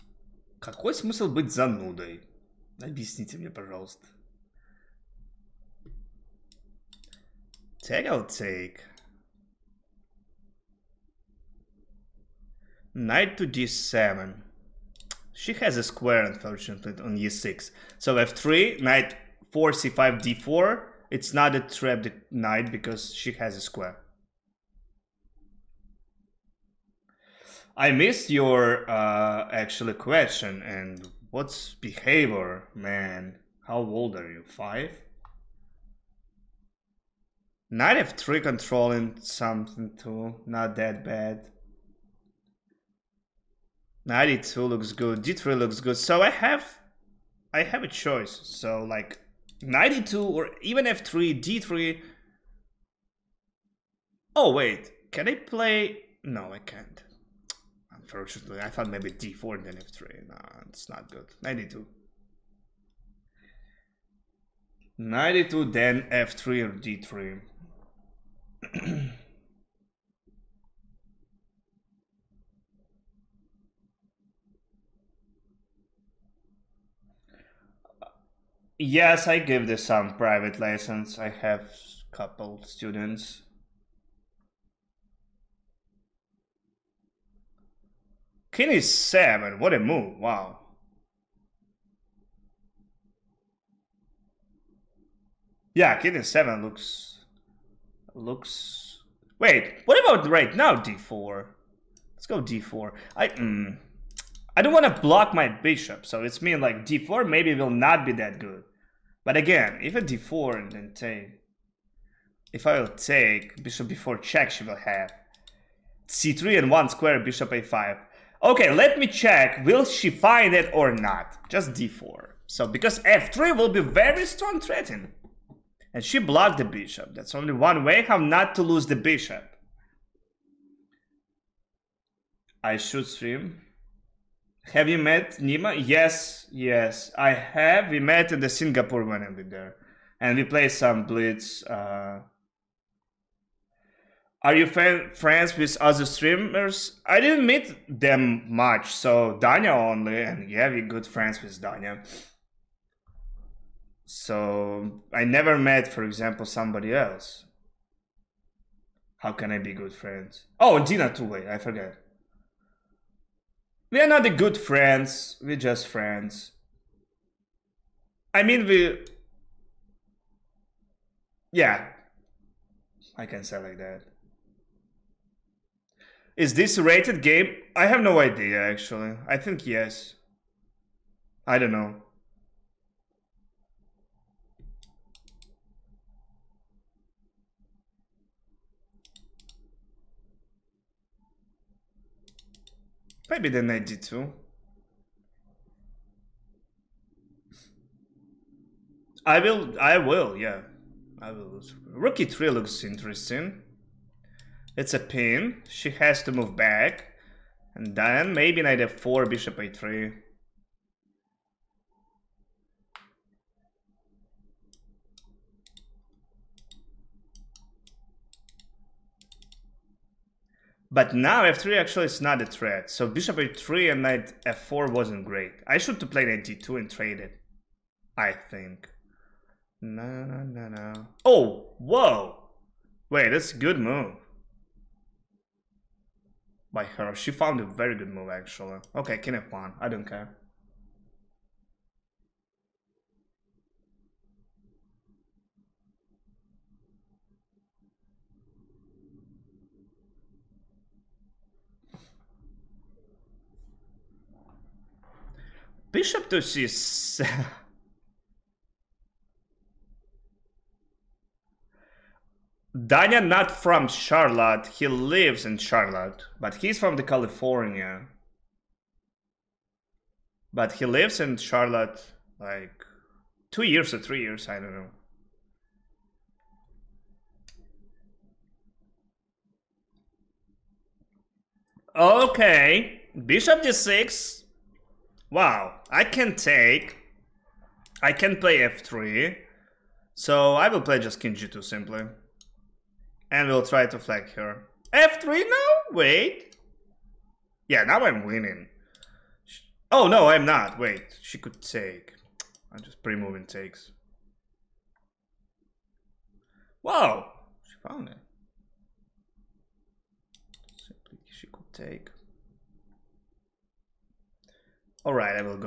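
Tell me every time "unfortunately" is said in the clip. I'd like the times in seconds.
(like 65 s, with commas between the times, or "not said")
16 s, 58 s.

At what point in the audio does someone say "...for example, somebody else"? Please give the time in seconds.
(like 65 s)
155 s.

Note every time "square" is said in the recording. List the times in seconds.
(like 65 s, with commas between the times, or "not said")
15 s, 23 s, 116 s.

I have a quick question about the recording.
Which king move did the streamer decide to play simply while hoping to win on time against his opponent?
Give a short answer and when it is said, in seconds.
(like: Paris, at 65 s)
King g2, at 291 s.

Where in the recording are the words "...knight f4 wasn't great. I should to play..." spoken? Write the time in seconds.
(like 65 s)
224 s.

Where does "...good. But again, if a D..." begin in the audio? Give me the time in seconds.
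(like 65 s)
108 s.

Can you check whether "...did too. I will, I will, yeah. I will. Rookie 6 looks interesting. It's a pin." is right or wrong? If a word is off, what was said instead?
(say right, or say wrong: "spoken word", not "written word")
wrong: "3", not "6".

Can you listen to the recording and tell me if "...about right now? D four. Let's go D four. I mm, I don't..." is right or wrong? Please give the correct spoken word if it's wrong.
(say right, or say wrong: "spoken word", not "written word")
right.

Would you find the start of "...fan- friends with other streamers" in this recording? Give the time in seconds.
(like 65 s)
144 s.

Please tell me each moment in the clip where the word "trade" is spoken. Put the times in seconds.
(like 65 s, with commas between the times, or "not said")
226 s.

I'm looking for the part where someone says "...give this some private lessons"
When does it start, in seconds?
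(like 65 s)
79 s.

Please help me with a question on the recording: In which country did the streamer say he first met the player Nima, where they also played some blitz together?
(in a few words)
Singapore.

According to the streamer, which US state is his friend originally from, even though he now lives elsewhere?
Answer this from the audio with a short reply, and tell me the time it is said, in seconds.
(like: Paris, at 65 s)
California, at 266 s.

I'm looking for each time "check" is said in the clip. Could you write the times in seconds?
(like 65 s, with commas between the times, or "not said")
114 s, 119 s.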